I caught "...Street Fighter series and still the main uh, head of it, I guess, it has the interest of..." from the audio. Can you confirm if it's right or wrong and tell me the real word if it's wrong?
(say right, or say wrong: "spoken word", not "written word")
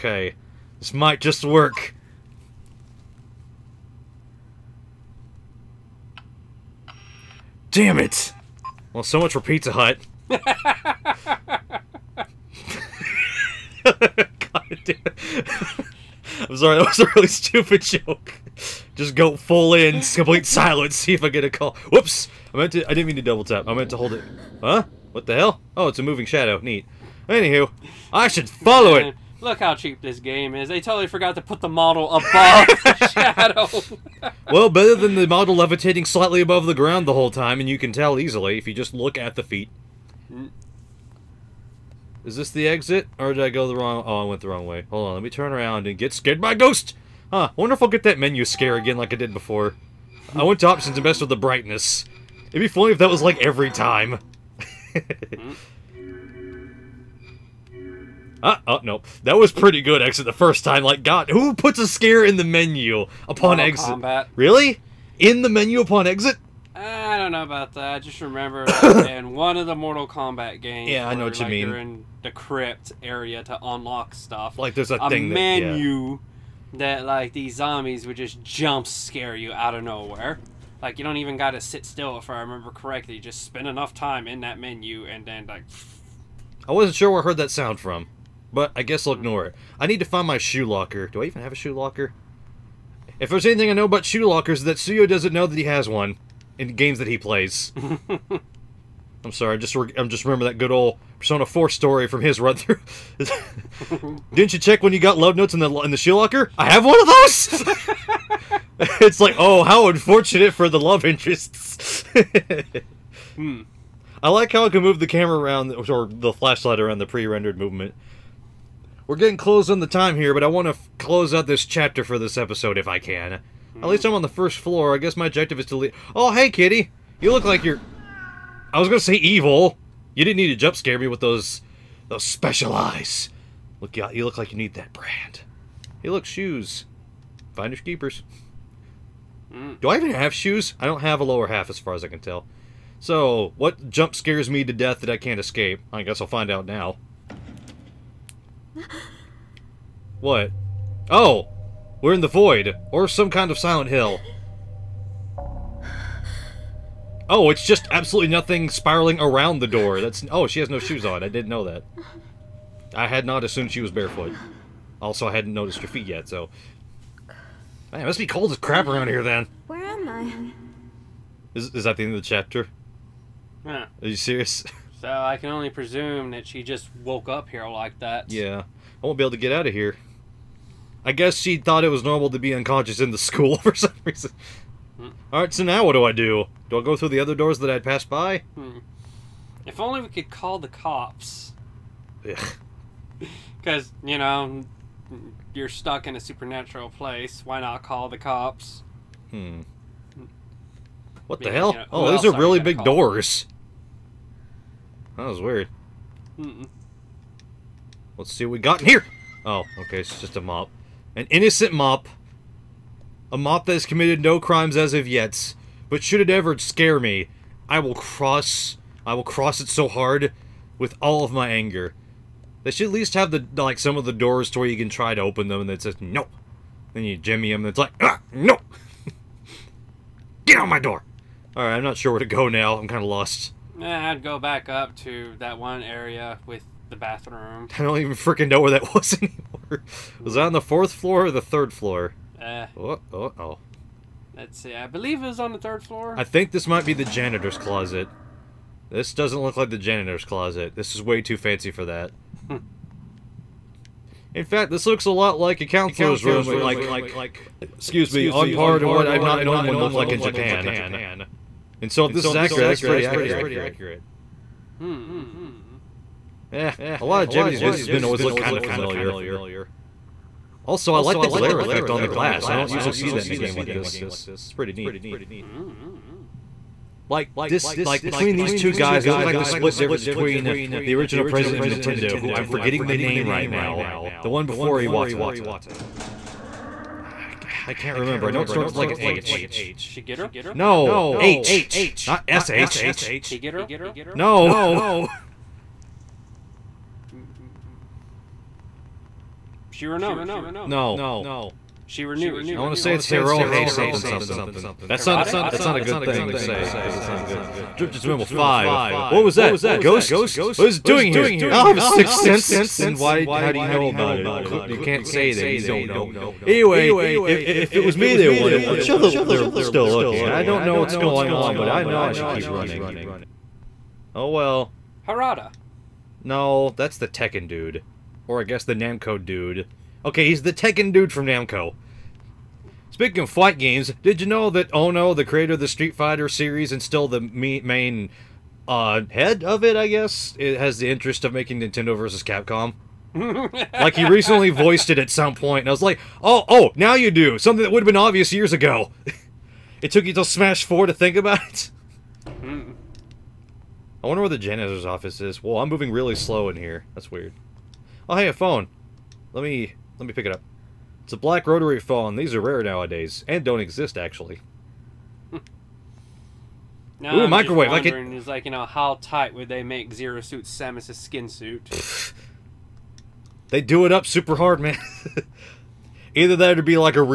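right.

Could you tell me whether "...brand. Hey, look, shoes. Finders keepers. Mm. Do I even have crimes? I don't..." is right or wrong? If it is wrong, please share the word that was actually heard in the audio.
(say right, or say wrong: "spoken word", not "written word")
wrong: "shoes", not "crimes".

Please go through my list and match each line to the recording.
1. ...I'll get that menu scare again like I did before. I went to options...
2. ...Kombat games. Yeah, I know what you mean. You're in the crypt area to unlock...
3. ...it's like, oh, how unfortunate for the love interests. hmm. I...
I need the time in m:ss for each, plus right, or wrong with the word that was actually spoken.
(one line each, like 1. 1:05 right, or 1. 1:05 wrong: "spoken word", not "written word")
1. 0:47 right
2. 1:10 right
3. 1:49 right.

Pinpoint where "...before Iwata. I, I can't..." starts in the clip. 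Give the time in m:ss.
4:44.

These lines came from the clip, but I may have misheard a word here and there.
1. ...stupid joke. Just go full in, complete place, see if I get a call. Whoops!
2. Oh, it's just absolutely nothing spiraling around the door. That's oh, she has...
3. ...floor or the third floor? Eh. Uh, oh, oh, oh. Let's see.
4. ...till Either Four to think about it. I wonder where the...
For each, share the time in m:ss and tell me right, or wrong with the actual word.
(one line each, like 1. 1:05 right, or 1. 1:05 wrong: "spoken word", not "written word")
1. 0:17 wrong: "silence", not "place"
2. 2:37 right
3. 4:00 right
4. 5:50 wrong: "Smash", not "Either".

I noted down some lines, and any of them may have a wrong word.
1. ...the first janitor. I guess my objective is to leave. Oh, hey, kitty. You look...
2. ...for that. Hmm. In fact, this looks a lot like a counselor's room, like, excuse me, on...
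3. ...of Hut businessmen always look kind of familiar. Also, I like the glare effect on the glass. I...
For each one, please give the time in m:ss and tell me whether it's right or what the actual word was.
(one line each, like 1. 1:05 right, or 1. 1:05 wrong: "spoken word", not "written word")
1. 2:04 wrong: "floor", not "janitor"
2. 4:11 right
3. 4:27 wrong: "Japanese", not "Hut".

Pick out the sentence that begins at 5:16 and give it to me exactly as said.
Anyway, if, if it was me they wanted, I'm sure they're still looking.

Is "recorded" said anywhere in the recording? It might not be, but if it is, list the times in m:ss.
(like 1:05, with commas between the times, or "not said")
not said.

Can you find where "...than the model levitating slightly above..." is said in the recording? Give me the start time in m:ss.
0:34.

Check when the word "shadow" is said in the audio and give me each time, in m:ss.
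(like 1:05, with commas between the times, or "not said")
0:26, 0:34.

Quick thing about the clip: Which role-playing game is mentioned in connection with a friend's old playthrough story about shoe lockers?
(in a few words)
Persona 4.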